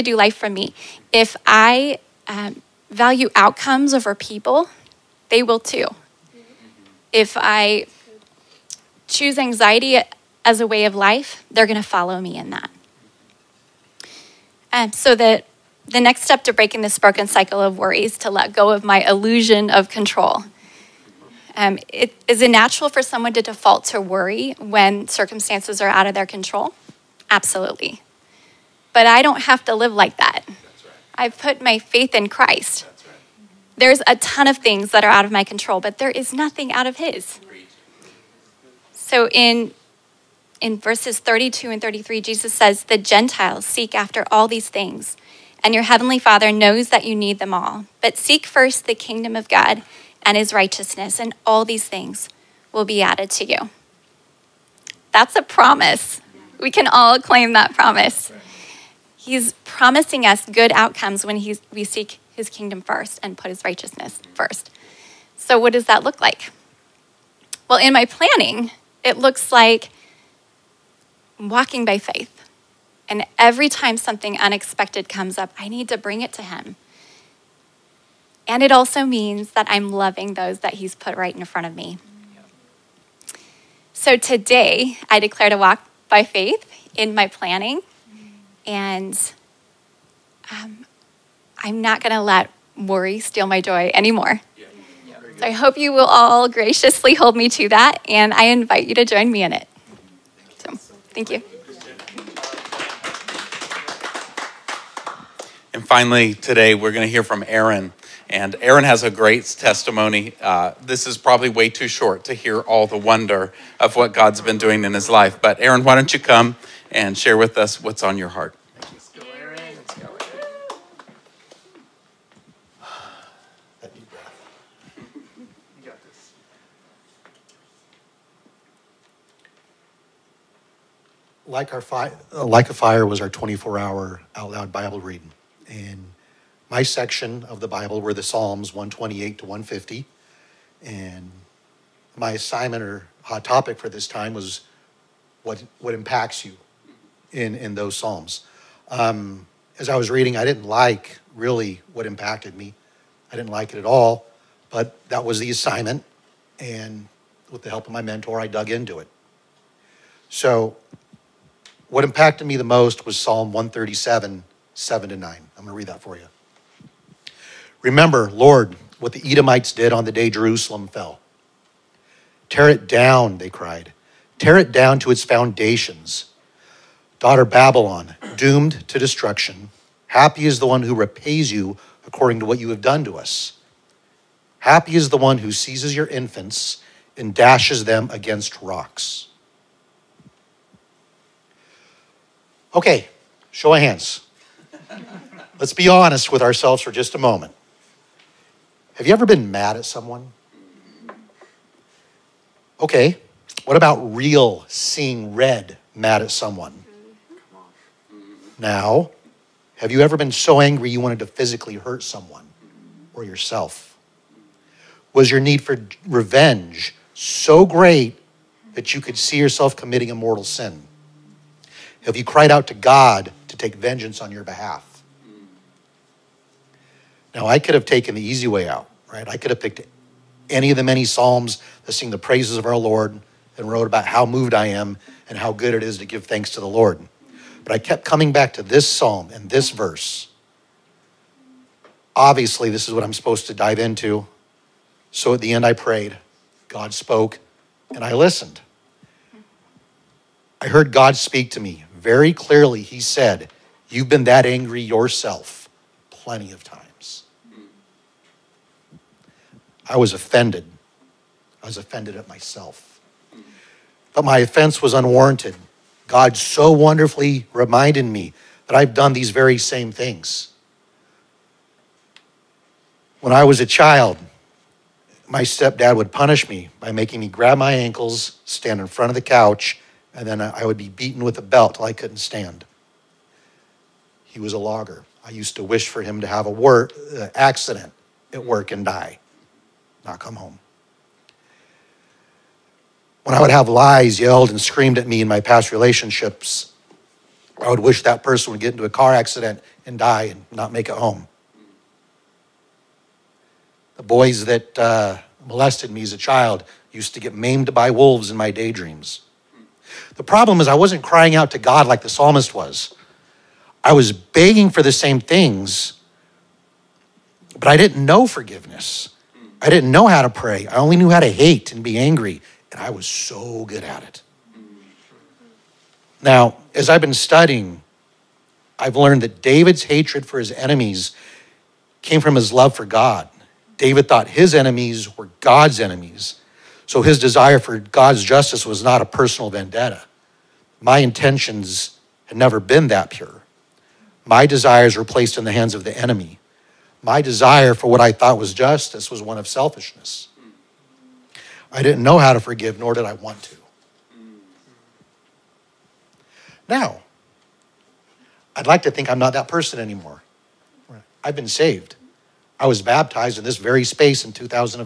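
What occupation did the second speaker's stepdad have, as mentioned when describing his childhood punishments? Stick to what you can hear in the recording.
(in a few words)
Logger.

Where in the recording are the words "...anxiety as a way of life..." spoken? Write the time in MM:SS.
00:09.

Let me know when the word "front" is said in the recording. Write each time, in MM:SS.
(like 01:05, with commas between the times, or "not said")
01:21, 04:38.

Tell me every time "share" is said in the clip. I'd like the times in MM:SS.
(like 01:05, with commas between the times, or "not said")
01:57.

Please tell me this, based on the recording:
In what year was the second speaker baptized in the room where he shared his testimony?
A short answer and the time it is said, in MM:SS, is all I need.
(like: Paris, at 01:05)
2018, at 06:04.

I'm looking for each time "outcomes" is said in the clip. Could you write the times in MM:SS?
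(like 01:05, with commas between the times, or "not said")
00:03, 01:00.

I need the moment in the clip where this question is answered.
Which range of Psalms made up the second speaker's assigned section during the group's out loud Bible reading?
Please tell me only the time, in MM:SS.
02:18.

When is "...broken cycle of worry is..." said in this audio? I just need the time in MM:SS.
00:16.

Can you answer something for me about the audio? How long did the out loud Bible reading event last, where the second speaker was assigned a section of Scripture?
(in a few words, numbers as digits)
24 hours.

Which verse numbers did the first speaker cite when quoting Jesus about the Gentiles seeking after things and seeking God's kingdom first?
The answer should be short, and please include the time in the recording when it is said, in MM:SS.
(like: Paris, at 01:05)
32 and 33, at 00:41.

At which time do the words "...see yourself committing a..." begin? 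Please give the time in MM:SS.
03:39.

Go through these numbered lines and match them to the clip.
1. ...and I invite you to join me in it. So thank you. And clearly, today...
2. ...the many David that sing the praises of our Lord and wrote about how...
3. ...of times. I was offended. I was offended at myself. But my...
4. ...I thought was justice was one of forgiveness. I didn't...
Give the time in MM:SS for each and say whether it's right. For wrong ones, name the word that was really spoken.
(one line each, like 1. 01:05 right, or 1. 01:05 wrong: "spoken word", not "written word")
1. 01:38 wrong: "finally", not "clearly"
2. 03:50 wrong: "Psalms", not "David"
3. 04:16 right
4. 05:48 wrong: "selfishness", not "forgiveness".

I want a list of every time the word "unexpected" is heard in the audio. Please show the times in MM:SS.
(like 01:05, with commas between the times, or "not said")
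01:14.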